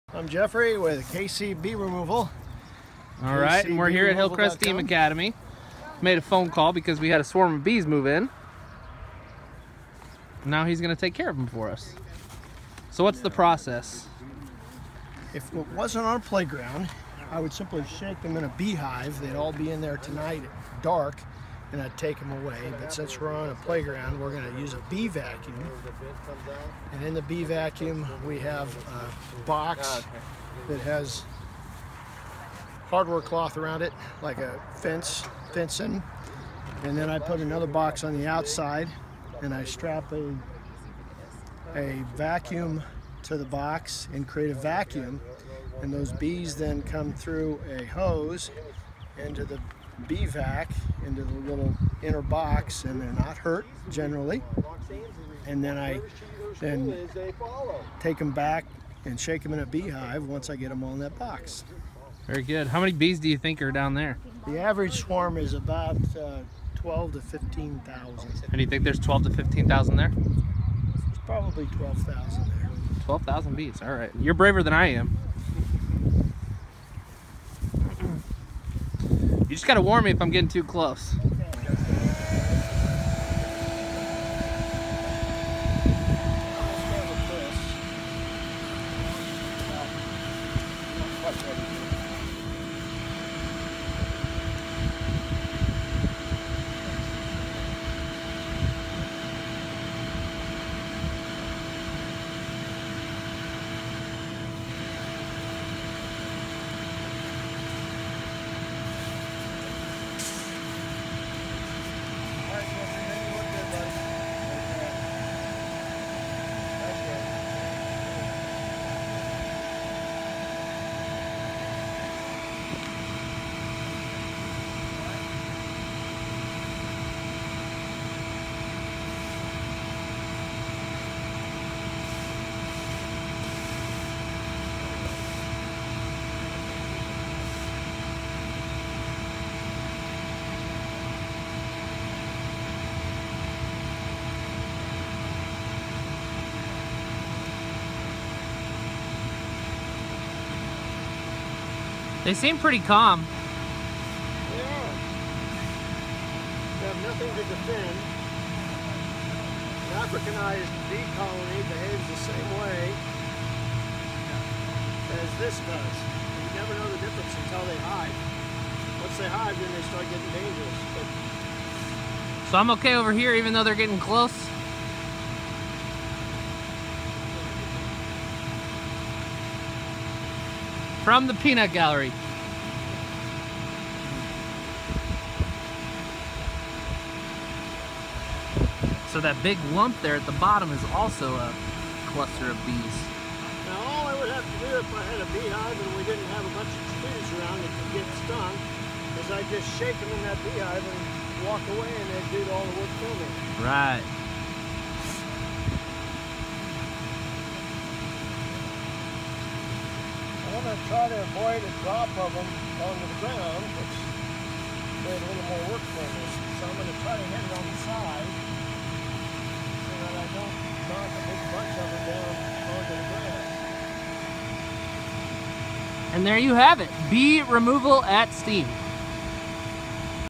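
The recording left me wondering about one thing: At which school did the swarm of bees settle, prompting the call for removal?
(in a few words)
Hillcrest Steam Academy.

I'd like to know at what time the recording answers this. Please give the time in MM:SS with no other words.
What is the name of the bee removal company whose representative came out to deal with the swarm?
00:01.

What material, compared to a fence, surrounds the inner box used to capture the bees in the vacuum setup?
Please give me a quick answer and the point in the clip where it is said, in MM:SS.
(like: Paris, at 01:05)
hardware cloth, at 00:32.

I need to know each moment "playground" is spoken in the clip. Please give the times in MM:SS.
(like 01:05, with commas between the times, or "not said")
00:16, 00:23.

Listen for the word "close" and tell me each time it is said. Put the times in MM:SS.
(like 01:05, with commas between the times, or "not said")
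01:20, 02:53.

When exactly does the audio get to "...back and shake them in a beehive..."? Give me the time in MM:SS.
00:58.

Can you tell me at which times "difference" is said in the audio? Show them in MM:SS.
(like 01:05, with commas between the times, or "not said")
02:47.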